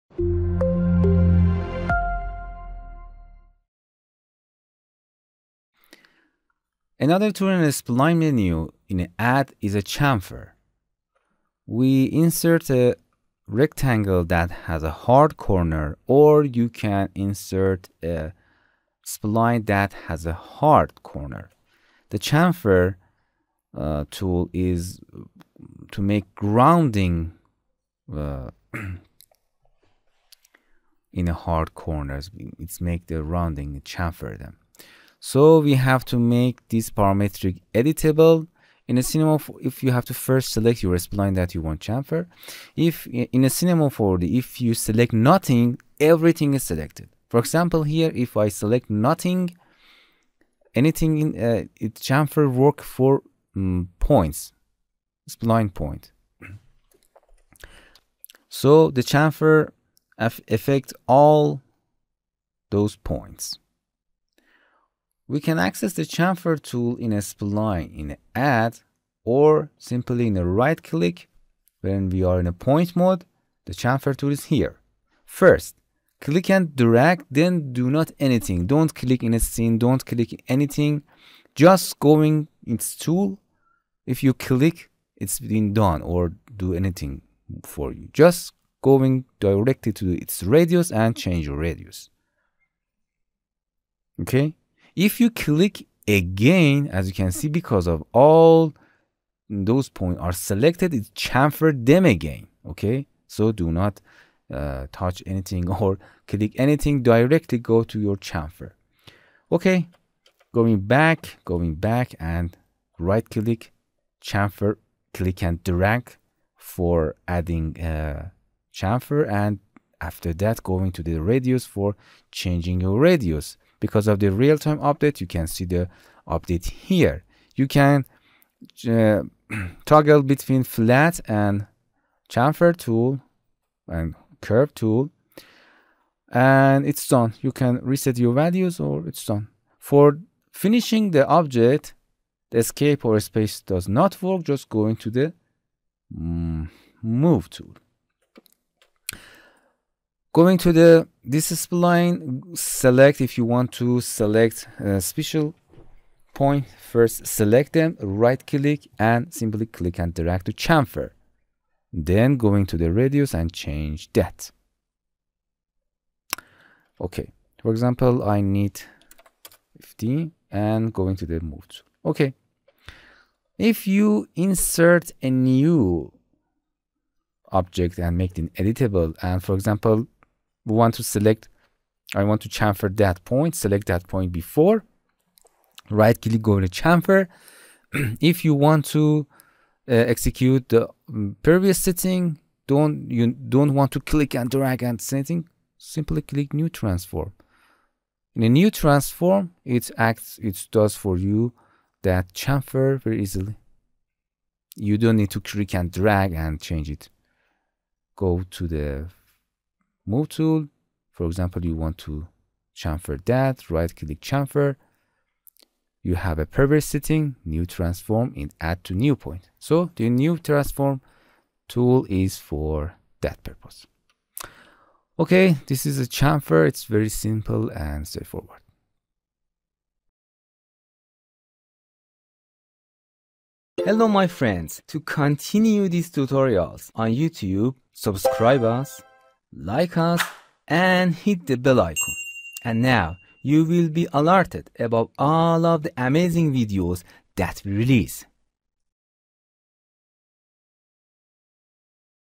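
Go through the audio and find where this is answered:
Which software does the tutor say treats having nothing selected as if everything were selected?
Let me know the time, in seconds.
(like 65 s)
43 s.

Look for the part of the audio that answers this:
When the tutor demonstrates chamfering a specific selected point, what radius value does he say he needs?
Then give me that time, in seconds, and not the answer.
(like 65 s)
169 s.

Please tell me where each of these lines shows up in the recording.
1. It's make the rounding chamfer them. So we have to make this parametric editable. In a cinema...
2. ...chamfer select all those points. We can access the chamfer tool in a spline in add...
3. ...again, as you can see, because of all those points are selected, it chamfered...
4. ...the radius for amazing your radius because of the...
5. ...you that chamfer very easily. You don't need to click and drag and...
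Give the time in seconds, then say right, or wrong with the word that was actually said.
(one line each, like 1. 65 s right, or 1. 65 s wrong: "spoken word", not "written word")
1. 32 s right
2. 59 s wrong: "affect", not "select"
3. 96 s right
4. 121 s wrong: "changing", not "amazing"
5. 201 s right.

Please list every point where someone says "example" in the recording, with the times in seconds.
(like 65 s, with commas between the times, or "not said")
47 s, 167 s, 179 s, 211 s.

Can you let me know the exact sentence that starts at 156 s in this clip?
First select them, right click and simply click and drag to chamfer.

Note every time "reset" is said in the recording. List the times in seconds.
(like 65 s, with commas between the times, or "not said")
137 s.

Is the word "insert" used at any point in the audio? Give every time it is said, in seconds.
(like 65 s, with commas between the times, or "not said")
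12 s, 17 s, 174 s.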